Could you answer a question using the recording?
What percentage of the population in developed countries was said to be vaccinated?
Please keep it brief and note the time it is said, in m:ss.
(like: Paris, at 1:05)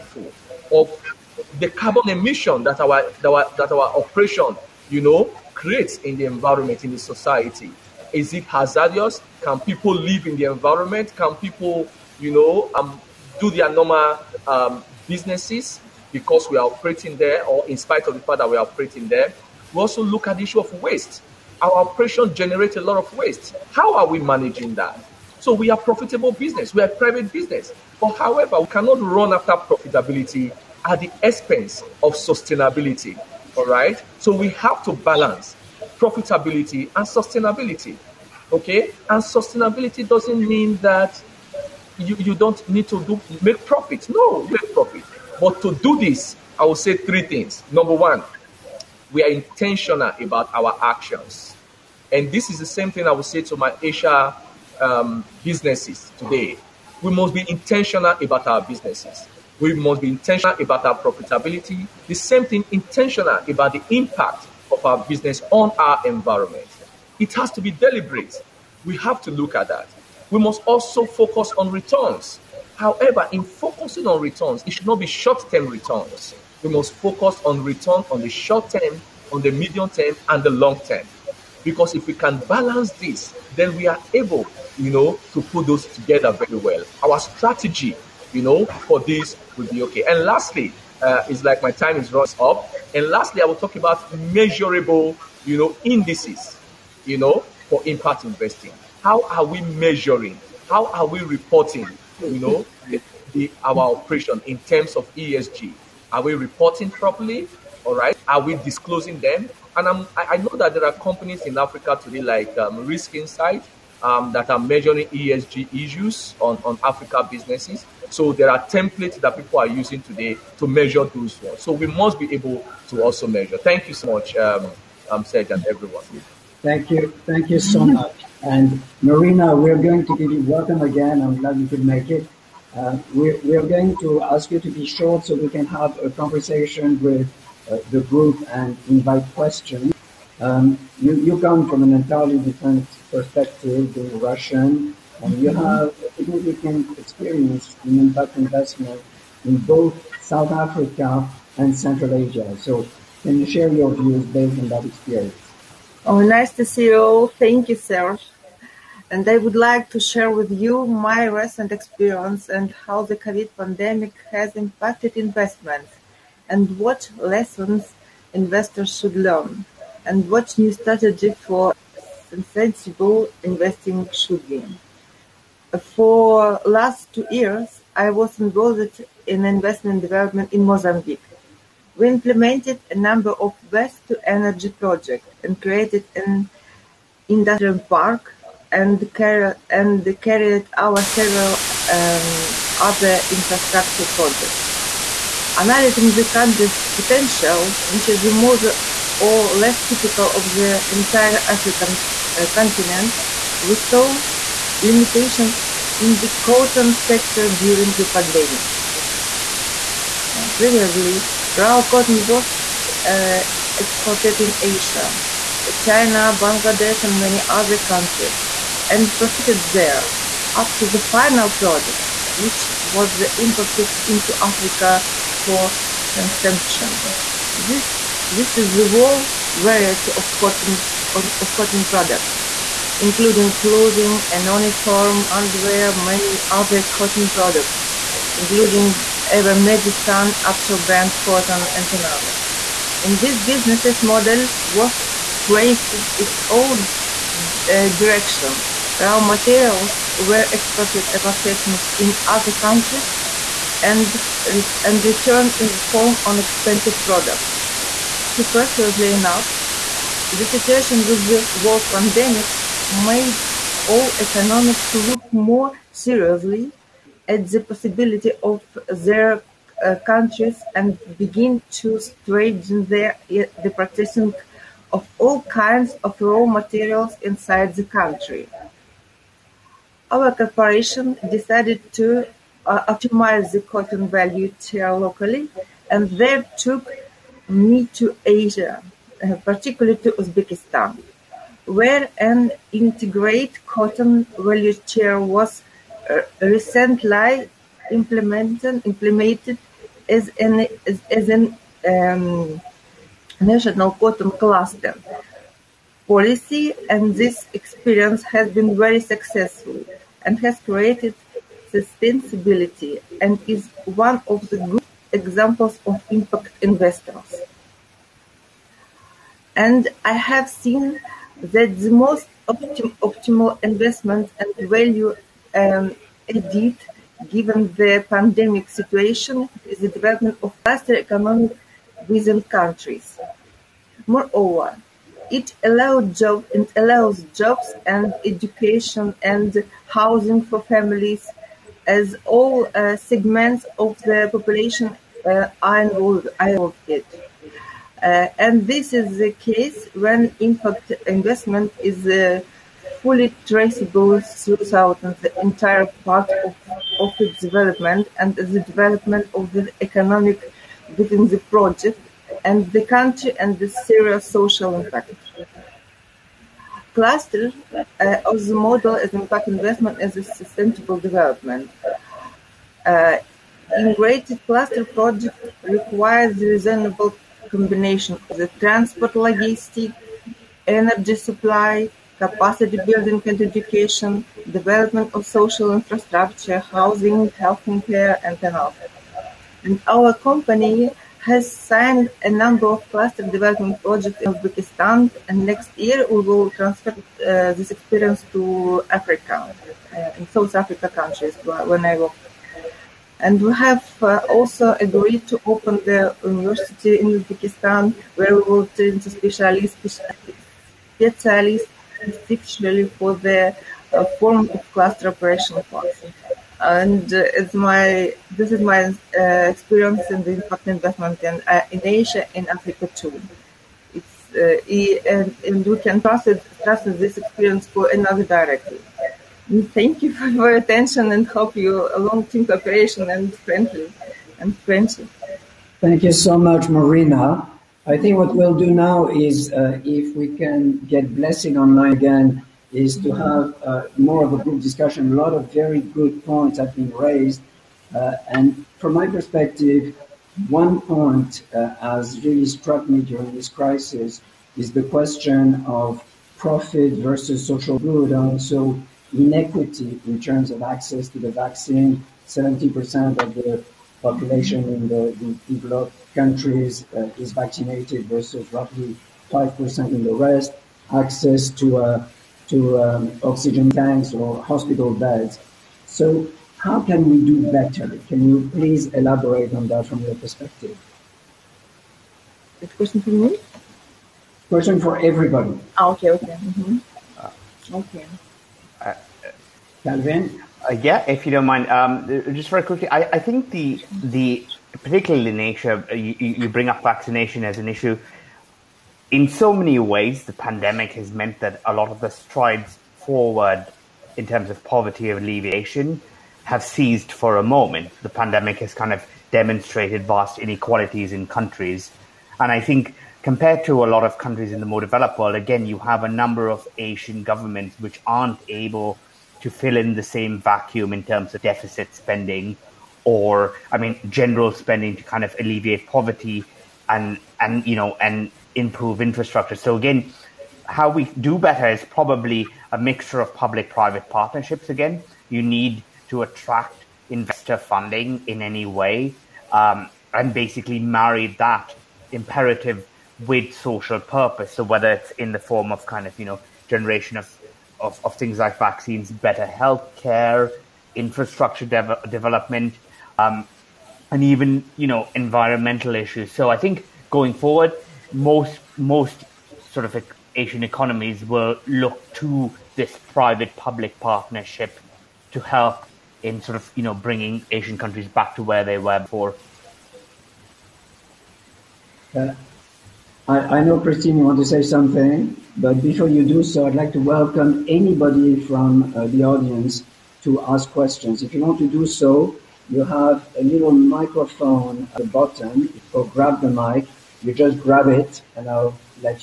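70%, at 7:42.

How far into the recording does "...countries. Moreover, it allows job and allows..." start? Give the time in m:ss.
5:32.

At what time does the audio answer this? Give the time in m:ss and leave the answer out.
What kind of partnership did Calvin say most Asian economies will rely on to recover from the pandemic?
9:23.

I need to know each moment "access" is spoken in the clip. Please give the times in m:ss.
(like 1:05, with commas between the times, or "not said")
7:40, 7:50.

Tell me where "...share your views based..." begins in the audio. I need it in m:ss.
2:33.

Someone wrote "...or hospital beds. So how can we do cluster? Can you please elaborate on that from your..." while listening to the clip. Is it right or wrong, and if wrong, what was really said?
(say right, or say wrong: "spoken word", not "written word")
wrong: "better", not "cluster".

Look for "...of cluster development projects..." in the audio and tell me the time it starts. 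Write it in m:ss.
6:32.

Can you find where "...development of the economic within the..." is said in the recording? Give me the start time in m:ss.
5:58.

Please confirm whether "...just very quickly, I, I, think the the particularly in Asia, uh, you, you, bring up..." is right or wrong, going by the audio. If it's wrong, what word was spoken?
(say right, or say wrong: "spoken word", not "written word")
right.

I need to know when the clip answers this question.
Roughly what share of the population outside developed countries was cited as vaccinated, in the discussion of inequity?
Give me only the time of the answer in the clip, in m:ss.
7:49.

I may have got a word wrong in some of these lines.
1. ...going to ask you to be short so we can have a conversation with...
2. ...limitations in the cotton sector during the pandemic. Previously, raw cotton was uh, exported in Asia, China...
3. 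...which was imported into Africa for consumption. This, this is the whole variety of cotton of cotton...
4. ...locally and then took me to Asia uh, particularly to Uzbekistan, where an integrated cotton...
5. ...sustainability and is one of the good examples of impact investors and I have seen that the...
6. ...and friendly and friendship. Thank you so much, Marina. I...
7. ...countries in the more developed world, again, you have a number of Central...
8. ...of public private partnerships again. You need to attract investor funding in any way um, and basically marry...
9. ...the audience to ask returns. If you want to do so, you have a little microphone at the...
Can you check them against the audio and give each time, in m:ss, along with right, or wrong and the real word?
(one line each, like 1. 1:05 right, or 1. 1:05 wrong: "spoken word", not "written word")
1. 2:13 right
2. 3:24 right
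3. 3:42 right
4. 4:44 right
5. 5:11 right
6. 7:13 right
7. 8:34 wrong: "Asian", not "Central"
8. 8:53 right
9. 9:39 wrong: "questions", not "returns".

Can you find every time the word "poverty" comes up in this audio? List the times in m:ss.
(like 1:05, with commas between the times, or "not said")
8:24, 8:45.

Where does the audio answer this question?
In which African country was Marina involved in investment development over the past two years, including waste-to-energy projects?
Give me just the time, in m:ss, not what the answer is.
3:00.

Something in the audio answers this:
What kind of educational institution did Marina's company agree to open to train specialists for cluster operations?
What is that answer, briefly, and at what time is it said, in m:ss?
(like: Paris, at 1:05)
university, at 6:46.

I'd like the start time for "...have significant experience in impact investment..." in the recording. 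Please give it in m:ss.
2:25.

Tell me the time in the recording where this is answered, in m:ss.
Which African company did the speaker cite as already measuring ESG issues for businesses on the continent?
1:52.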